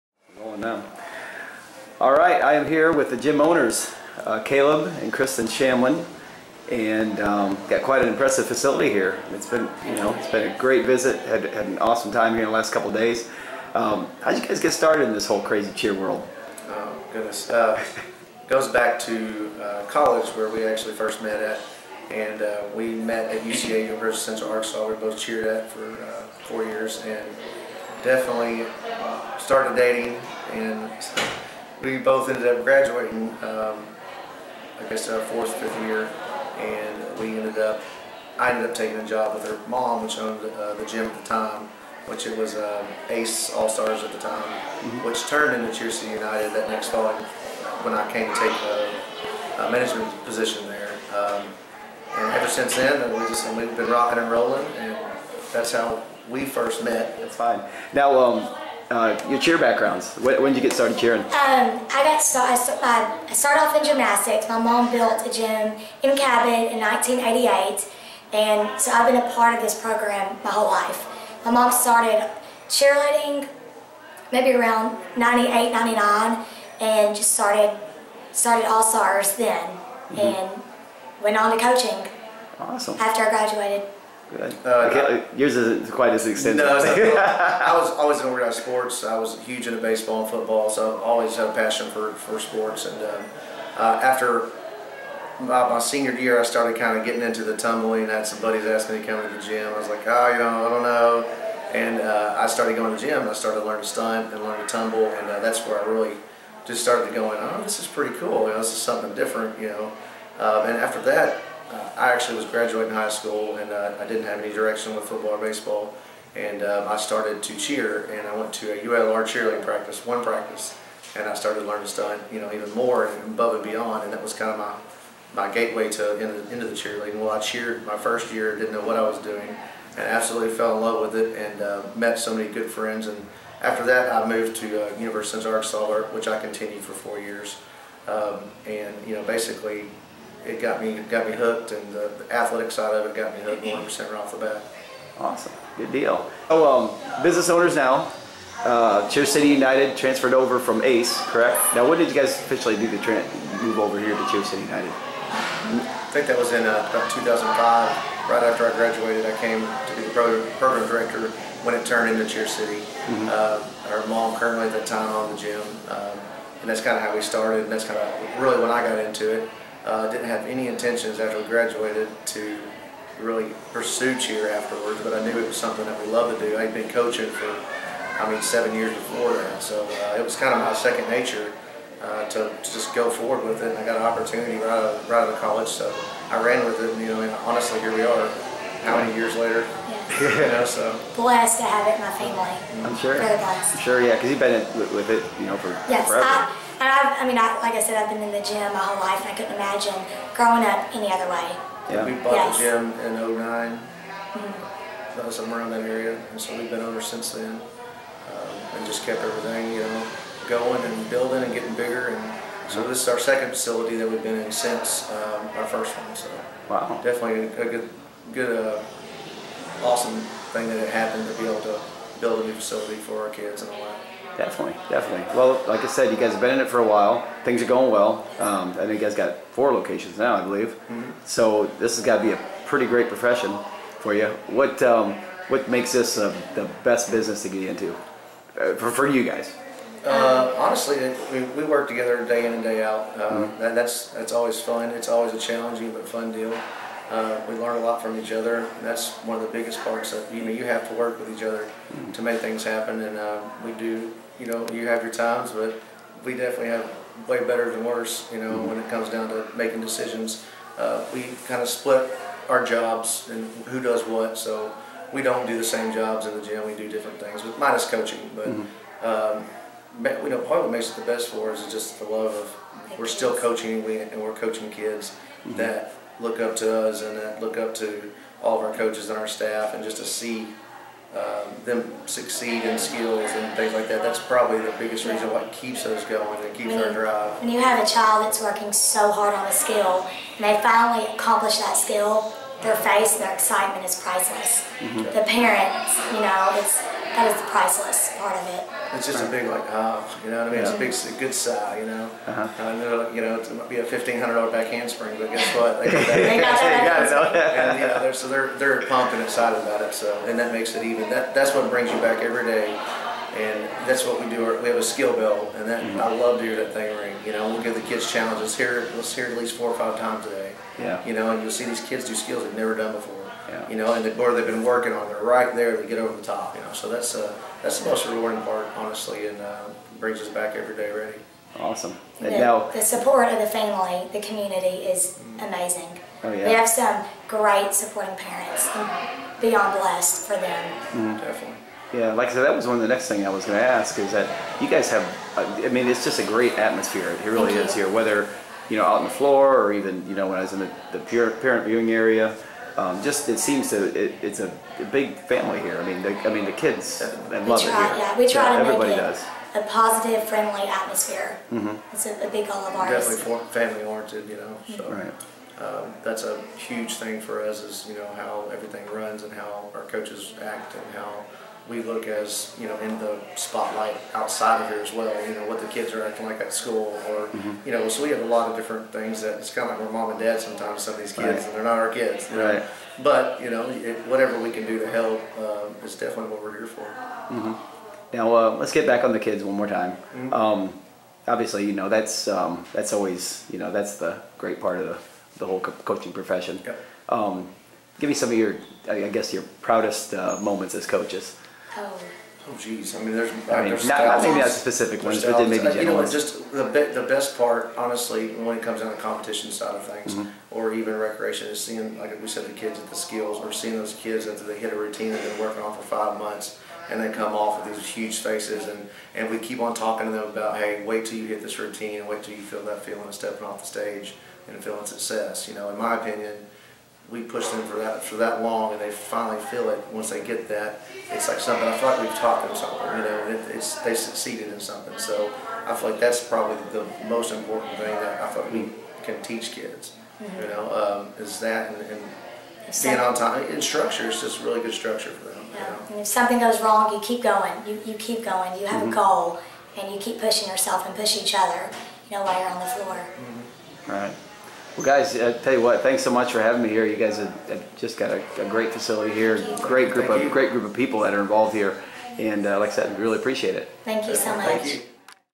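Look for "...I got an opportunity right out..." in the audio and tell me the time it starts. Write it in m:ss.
3:03.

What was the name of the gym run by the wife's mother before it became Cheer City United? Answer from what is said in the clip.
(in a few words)
Ace All Stars.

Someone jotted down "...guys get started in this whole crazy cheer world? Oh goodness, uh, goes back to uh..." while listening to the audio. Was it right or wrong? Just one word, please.
right.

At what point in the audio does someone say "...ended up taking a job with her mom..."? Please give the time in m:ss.
0:38.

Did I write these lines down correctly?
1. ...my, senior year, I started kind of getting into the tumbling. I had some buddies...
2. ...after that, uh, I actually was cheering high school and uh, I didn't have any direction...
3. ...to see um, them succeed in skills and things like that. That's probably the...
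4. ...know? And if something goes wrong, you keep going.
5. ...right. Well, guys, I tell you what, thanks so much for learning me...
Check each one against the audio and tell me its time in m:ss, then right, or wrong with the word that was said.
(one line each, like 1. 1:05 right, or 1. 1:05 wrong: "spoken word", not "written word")
1. 1:35 right
2. 1:50 wrong: "graduating", not "cheering"
3. 4:39 right
4. 7:25 right
5. 7:34 wrong: "having", not "learning".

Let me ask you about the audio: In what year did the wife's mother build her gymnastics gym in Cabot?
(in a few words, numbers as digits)
1988.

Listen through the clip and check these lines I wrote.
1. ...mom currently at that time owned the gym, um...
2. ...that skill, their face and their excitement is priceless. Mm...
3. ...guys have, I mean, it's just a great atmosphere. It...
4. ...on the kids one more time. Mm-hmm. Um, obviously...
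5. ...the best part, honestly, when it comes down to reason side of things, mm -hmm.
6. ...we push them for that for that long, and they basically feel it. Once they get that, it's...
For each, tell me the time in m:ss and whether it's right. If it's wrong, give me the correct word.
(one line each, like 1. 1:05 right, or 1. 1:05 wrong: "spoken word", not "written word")
1. 2:44 right
2. 4:51 right
3. 5:44 right
4. 6:29 right
5. 6:46 wrong: "competition", not "reason"
6. 7:07 wrong: "finally", not "basically".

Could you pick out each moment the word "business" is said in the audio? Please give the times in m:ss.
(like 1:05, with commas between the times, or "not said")
2:27, 3:57.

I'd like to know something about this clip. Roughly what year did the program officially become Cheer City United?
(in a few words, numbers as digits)
2005.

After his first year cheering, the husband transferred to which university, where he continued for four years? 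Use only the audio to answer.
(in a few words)
University of Arkansas.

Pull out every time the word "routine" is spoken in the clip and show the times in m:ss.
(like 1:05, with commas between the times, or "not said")
6:54, 7:01.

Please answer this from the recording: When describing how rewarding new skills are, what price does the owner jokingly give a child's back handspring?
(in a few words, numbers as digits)
$1,500.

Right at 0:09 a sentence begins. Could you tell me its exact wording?
It's been, you know, it's been a great visit.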